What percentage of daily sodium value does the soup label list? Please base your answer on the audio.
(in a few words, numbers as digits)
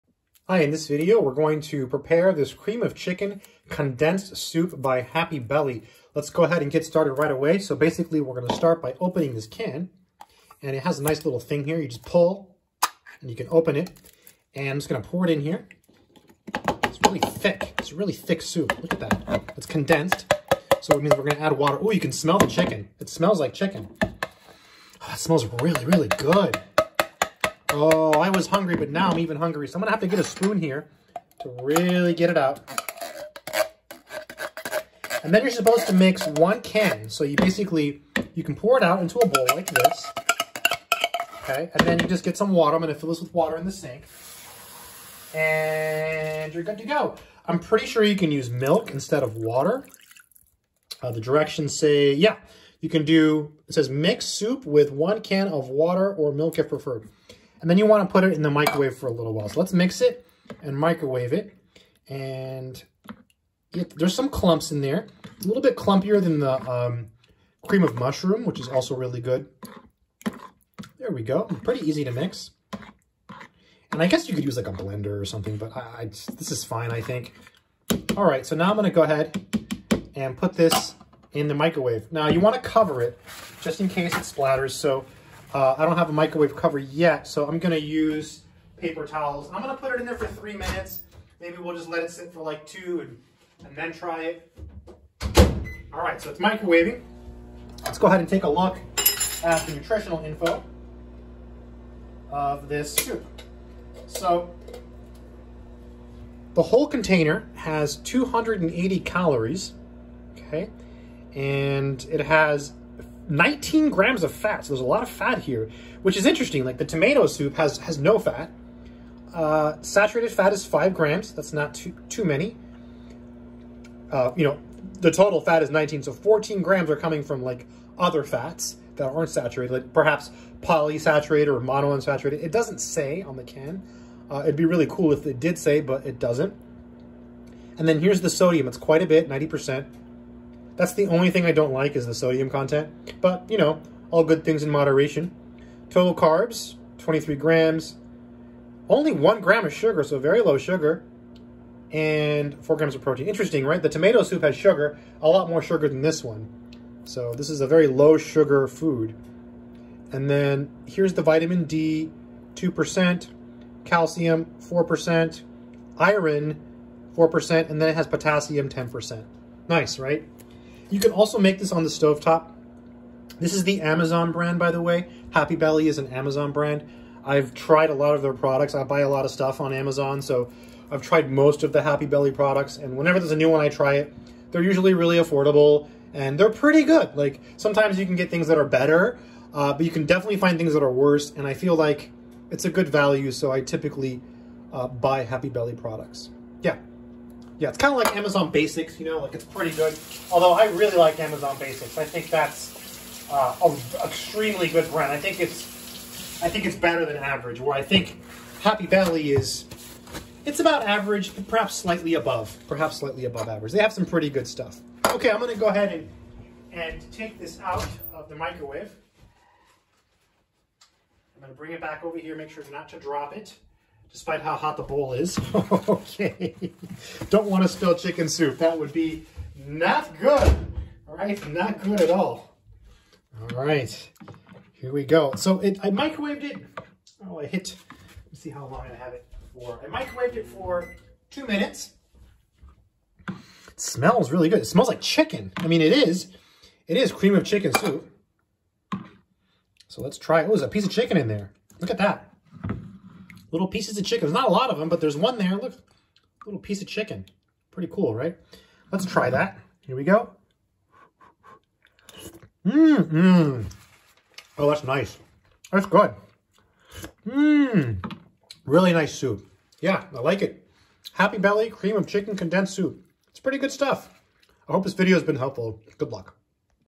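90%.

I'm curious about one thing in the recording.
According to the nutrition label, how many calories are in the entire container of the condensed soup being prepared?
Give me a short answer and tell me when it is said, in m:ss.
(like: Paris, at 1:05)
280, at 1:47.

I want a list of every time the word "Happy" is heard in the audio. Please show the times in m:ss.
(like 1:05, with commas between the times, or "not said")
0:04, 2:55, 3:01, 3:15, 3:28, 4:31.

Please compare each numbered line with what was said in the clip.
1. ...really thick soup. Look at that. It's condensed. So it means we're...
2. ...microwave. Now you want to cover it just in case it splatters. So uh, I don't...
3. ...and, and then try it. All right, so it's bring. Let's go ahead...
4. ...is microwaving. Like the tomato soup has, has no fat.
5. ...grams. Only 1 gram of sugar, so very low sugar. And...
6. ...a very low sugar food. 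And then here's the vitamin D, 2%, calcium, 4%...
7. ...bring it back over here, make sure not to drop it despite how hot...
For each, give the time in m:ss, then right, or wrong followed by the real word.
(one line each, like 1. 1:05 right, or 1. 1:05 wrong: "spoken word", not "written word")
1. 0:17 right
2. 1:21 right
3. 1:33 wrong: "microwaving", not "bring"
4. 1:56 wrong: "interesting", not "microwaving"
5. 2:27 right
6. 2:37 right
7. 3:41 right.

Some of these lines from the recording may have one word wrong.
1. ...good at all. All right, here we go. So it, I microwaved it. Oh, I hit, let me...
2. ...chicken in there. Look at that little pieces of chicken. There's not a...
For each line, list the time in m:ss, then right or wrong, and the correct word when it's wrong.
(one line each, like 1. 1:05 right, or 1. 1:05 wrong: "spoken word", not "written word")
1. 3:51 right
2. 4:10 right.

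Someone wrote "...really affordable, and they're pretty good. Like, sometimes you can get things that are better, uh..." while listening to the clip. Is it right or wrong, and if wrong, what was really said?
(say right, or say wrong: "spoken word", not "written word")
right.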